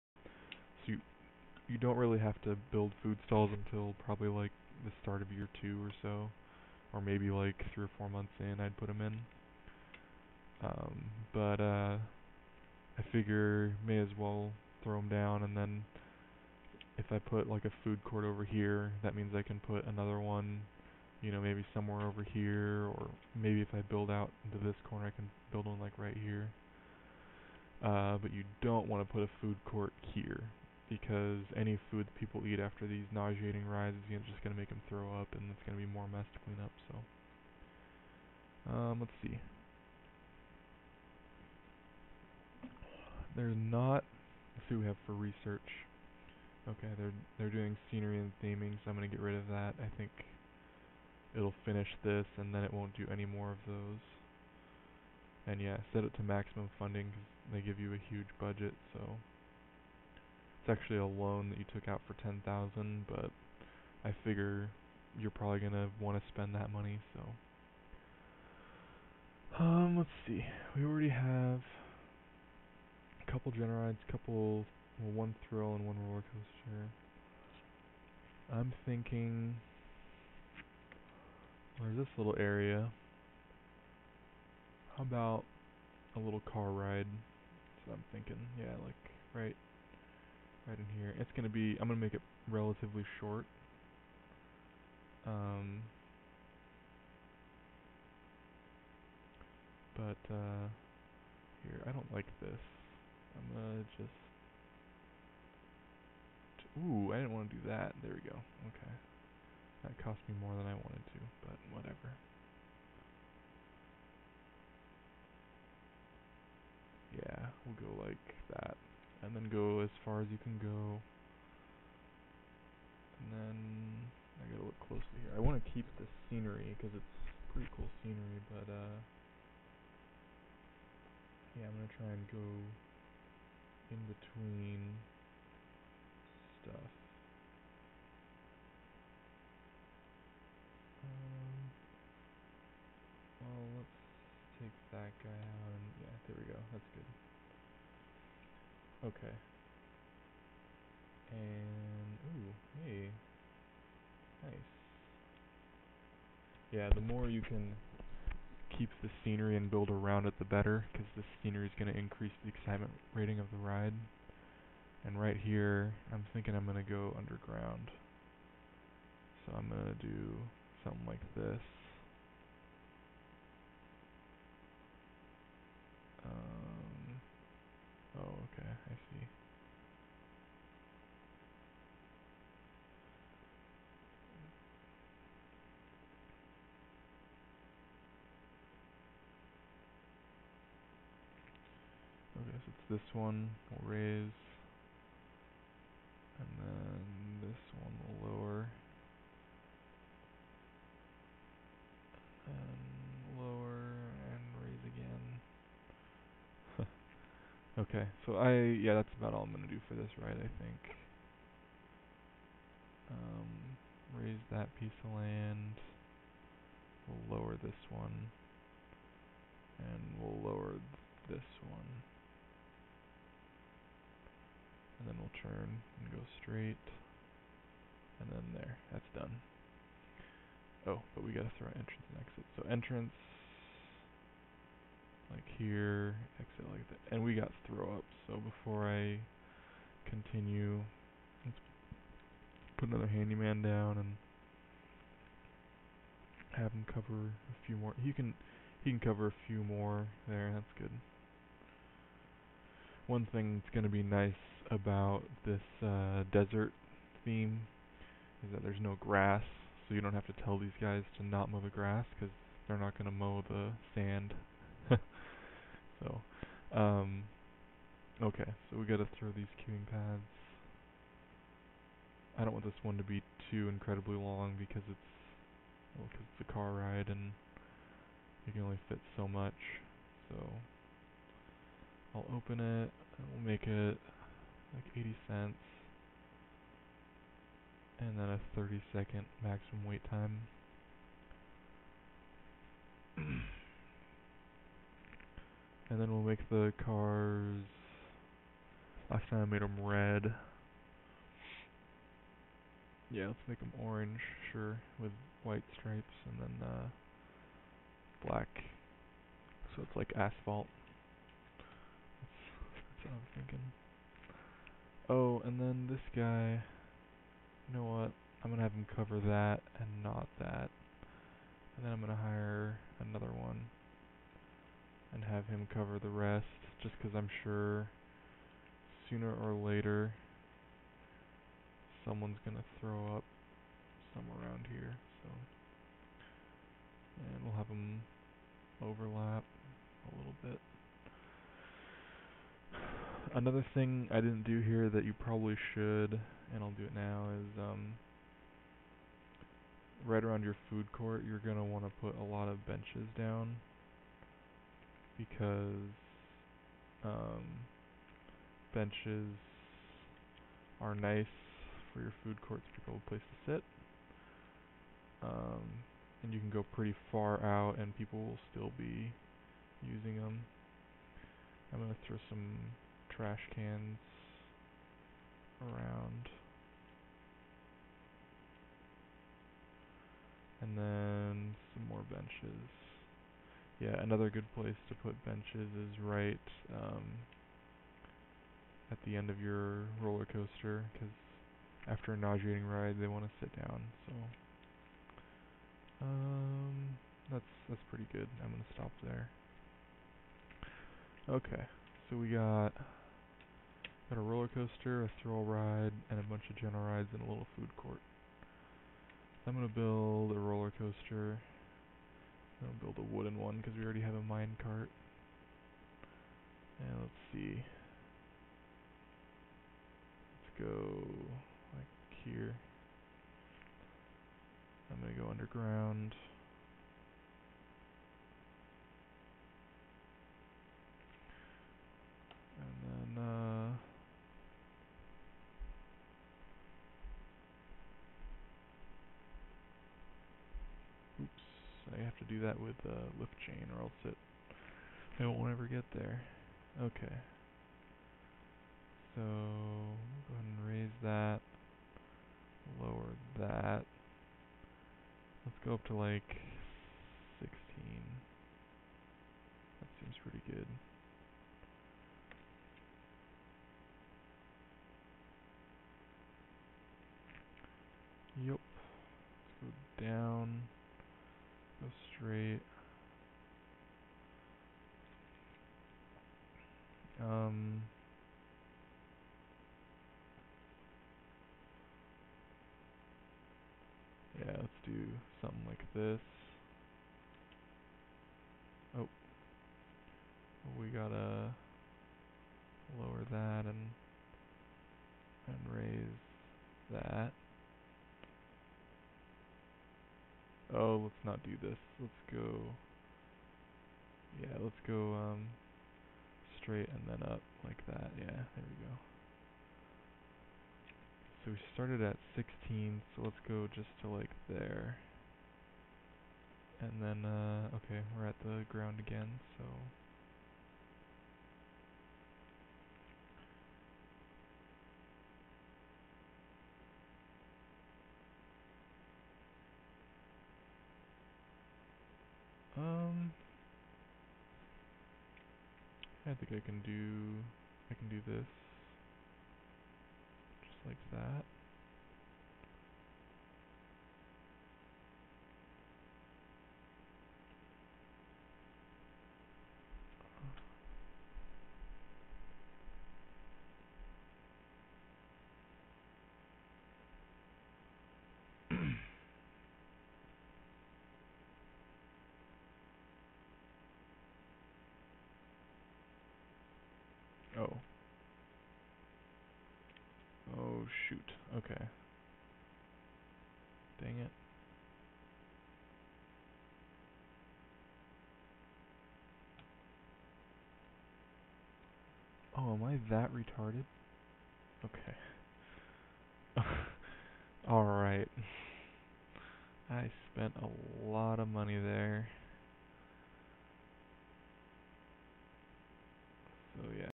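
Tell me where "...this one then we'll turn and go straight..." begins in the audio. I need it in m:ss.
3:41.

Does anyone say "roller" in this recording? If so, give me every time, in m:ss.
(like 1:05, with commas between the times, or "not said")
1:16, 6:30, 6:44, 6:50.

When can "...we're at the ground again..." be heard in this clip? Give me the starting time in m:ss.
8:38.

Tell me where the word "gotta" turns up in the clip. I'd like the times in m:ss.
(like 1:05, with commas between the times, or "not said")
2:04, 3:51, 8:10.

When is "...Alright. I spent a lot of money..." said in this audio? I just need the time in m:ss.
9:47.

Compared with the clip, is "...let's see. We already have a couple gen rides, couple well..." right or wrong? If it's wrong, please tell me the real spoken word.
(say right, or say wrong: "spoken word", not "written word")
right.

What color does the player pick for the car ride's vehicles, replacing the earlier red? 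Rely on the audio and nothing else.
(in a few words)
orange.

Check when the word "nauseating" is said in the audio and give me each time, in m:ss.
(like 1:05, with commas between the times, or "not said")
0:33, 6:32.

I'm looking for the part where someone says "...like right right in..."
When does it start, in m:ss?
1:28.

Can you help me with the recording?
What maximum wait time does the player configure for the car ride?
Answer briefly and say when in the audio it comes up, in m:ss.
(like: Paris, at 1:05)
30 seconds, at 4:48.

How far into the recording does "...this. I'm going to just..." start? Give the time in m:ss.
1:42.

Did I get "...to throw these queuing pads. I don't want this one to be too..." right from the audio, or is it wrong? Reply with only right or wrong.
right.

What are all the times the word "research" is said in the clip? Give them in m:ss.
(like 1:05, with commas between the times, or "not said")
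0:45.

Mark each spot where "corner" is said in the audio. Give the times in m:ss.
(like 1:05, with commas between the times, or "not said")
0:24.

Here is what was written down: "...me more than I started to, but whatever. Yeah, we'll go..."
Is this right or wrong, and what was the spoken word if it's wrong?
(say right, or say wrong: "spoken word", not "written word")
wrong: "wanted", not "started".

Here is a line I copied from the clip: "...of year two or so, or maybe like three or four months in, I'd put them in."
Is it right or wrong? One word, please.
right.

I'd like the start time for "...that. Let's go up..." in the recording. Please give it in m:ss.
7:33.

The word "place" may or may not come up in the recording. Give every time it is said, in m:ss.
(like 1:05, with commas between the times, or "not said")
6:03, 6:24.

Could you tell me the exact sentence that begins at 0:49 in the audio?
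I think it'll finish this, and then it won't do any more of those.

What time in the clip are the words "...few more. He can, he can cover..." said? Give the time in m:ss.
4:07.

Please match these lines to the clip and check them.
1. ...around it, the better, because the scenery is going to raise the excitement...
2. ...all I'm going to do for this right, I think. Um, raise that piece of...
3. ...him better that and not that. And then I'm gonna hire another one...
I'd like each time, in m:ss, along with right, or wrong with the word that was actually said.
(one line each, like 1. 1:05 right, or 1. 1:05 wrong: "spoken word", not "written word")
1. 2:39 wrong: "increase", not "raise"
2. 3:29 right
3. 5:18 wrong: "cover", not "better".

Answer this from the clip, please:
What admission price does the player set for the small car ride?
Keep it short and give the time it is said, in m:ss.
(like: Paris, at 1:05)
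80 cents, at 4:44.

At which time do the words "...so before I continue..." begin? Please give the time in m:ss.
3:58.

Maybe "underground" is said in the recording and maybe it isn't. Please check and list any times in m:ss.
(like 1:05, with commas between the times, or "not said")
2:47, 7:05.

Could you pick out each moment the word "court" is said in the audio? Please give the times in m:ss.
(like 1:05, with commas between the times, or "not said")
0:18, 0:29, 5:50, 6:02, 6:47.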